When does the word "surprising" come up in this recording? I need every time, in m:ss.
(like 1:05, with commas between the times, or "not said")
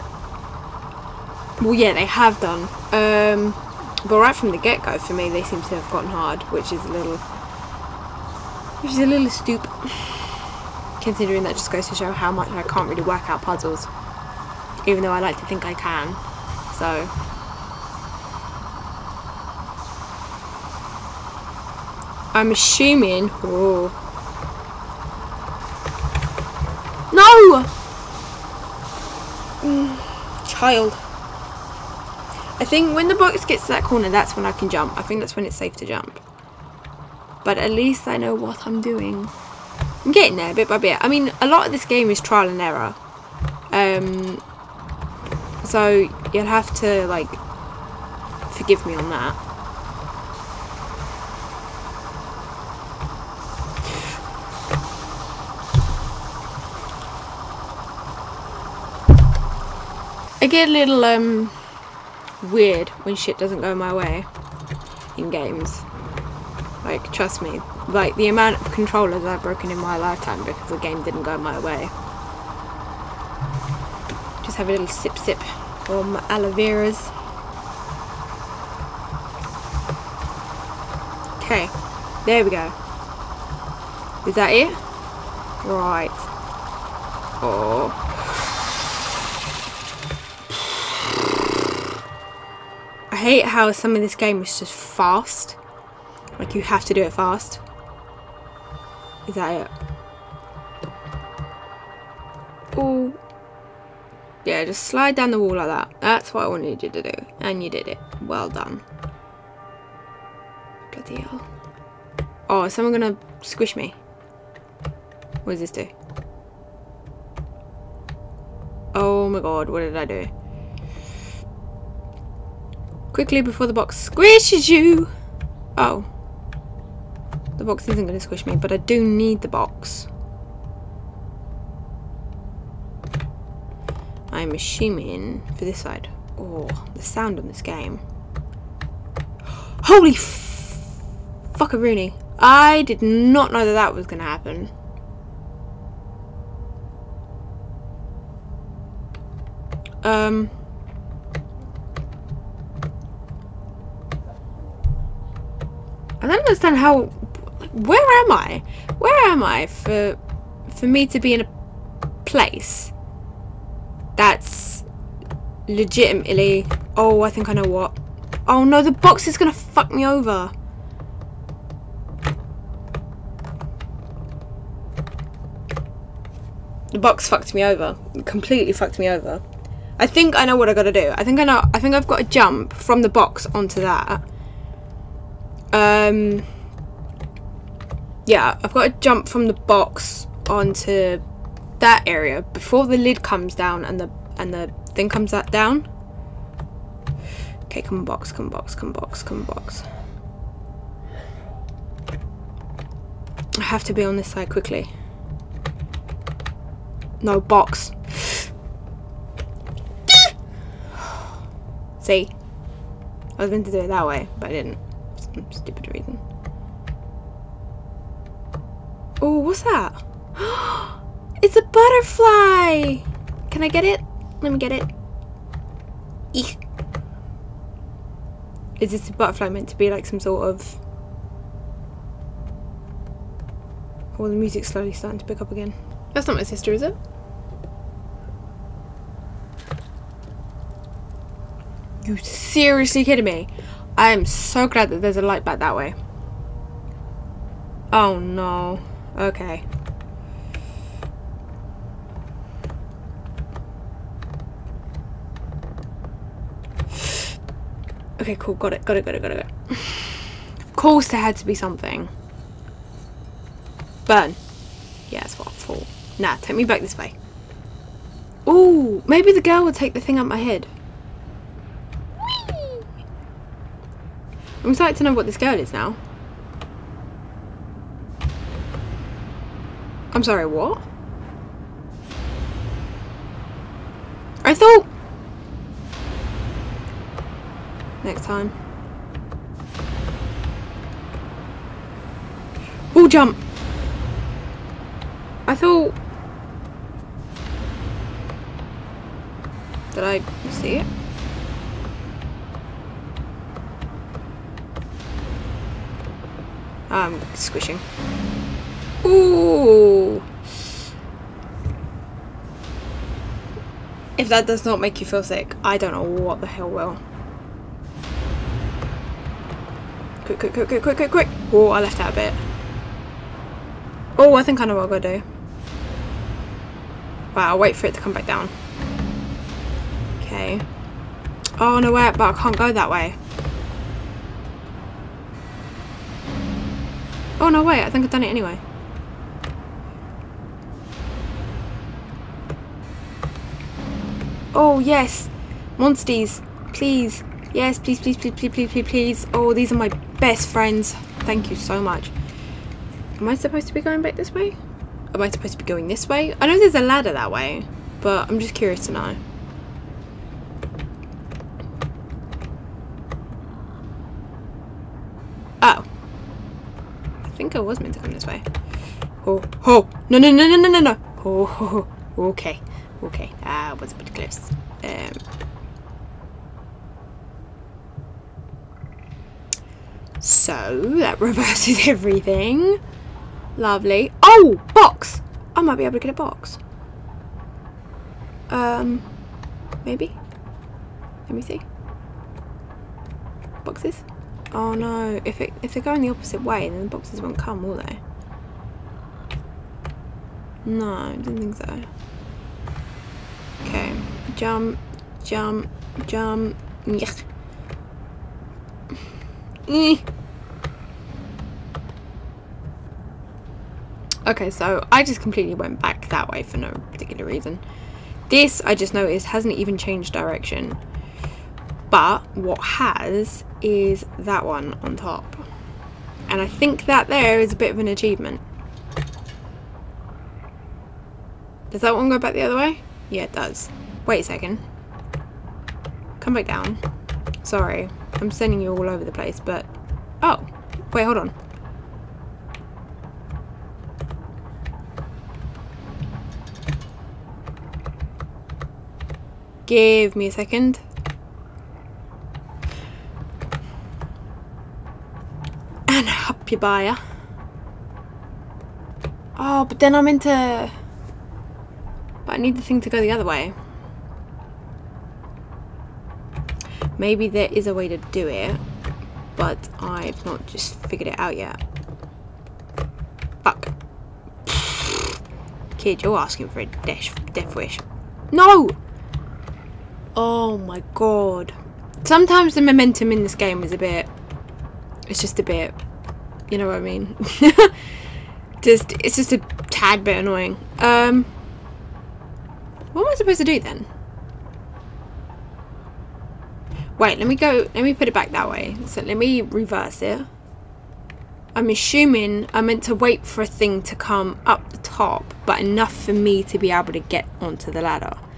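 not said.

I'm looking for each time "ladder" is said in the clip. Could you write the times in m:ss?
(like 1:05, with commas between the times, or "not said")
5:56, 8:27.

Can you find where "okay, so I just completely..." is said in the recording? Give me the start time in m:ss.
6:54.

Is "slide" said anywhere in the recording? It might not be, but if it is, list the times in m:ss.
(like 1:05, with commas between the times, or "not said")
1:44.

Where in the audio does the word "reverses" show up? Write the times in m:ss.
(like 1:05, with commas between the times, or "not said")
6:21, 8:19.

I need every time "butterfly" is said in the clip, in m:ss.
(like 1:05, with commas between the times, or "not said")
3:41, 3:49.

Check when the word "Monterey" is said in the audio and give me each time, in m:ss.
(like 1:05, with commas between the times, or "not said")
not said.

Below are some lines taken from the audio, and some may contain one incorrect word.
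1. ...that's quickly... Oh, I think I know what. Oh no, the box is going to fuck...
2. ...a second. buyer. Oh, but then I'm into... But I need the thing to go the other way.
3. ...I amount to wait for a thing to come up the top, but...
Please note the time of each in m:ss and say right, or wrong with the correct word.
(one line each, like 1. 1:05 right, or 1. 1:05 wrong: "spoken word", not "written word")
1. 2:44 wrong: "legitimately", not "quickly"
2. 7:30 right
3. 8:22 wrong: "meant", not "amount".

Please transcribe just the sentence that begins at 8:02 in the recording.
Sometimes the momentum in this game is a bit...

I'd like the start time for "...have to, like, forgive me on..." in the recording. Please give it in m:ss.
0:46.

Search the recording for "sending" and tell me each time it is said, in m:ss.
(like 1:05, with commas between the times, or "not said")
7:18.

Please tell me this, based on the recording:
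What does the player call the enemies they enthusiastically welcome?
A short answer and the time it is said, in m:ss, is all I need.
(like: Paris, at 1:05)
Monsters, at 5:45.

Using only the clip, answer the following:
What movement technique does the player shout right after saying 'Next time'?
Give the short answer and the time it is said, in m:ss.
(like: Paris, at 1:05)
Wall jump, at 4:52.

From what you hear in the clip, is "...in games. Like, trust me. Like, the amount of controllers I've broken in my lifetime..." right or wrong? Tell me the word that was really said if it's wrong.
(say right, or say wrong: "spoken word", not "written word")
right.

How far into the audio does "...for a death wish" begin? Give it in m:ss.
7:56.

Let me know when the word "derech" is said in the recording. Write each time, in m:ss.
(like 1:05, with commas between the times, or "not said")
not said.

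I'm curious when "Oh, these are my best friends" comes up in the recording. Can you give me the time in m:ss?
5:49.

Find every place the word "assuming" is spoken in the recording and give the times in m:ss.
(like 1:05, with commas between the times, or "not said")
0:22, 2:14, 8:21.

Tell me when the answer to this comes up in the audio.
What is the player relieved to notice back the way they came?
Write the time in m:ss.
4:05.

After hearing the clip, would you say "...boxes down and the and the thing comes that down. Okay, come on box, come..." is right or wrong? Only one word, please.
wrong.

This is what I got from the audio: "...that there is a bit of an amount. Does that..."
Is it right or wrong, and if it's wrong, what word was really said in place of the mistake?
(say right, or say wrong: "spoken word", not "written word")
wrong: "achievement", not "amount".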